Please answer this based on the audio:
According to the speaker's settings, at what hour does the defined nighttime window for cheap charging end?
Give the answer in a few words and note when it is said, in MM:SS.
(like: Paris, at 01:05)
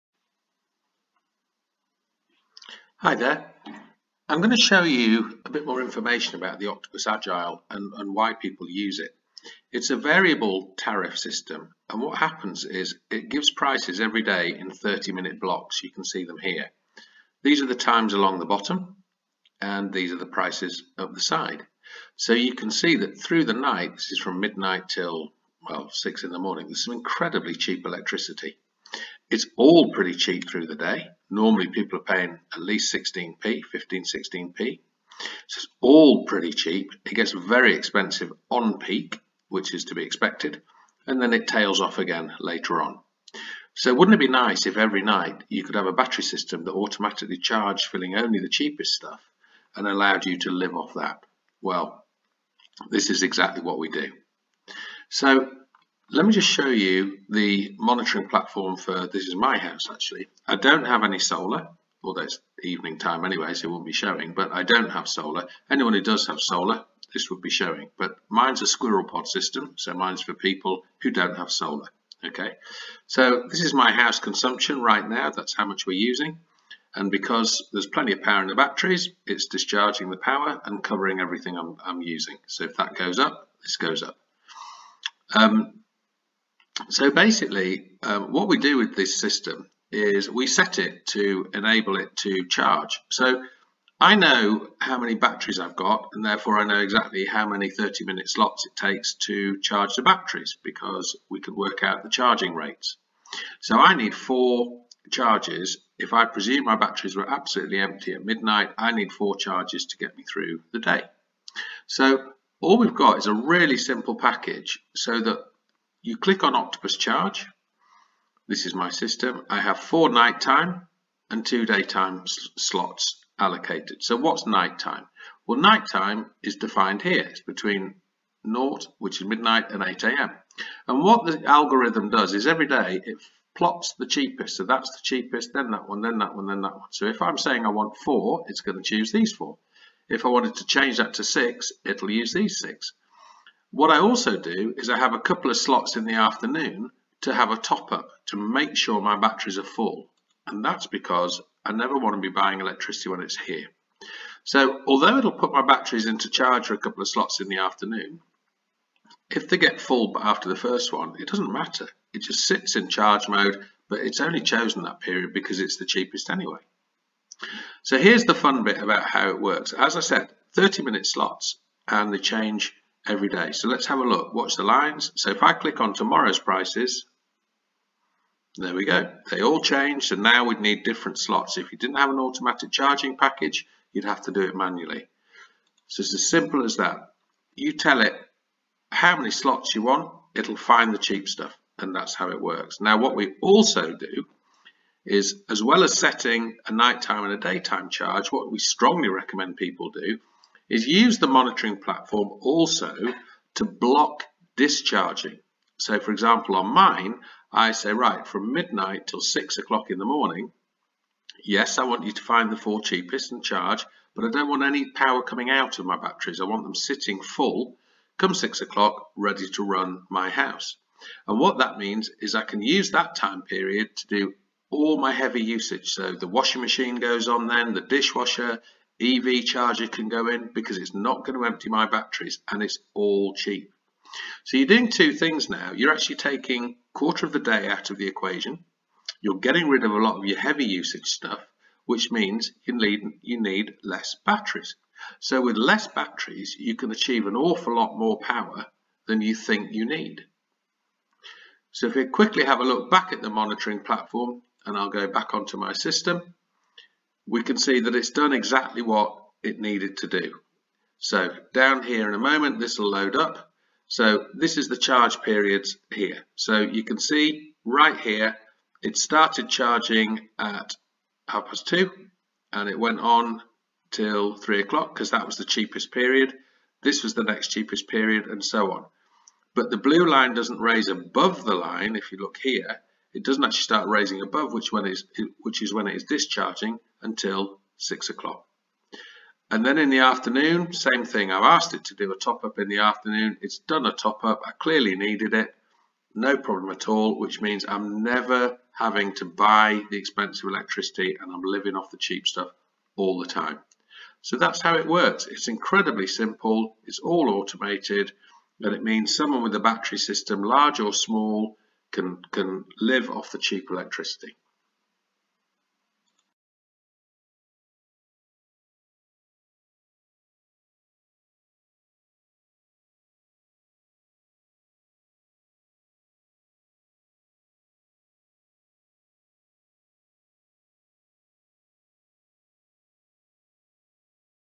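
8 a.m., at 02:09.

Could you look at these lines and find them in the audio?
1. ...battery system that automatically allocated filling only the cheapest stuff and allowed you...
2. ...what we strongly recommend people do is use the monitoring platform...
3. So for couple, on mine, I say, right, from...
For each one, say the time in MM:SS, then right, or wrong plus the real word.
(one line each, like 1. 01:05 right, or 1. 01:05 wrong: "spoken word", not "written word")
1. 00:45 wrong: "charged", not "allocated"
2. 03:18 right
3. 03:25 wrong: "example", not "couple".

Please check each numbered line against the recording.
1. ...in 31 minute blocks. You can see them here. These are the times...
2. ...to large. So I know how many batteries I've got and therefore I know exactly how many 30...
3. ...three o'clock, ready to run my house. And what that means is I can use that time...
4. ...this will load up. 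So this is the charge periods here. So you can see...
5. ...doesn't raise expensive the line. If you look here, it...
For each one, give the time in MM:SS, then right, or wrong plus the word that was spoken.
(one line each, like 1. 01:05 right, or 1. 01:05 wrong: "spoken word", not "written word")
1. 00:14 wrong: "30", not "31"
2. 01:32 wrong: "charge", not "large"
3. 03:38 wrong: "six", not "three"
4. 04:22 right
5. 04:40 wrong: "above", not "expensive".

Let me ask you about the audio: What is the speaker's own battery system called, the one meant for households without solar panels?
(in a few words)
squirrel pod.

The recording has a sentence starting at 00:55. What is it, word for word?
So let me just show you the monitoring platform for, this is my house actually.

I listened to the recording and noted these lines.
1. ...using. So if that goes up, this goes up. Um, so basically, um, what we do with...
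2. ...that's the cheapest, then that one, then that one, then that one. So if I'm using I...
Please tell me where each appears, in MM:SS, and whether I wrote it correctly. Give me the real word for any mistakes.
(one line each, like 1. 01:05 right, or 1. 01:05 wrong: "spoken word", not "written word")
1. 01:22 right
2. 02:14 wrong: "saying", not "using".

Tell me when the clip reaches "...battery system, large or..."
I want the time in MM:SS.
05:09.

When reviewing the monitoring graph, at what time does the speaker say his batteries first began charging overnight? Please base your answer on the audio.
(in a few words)
half past two.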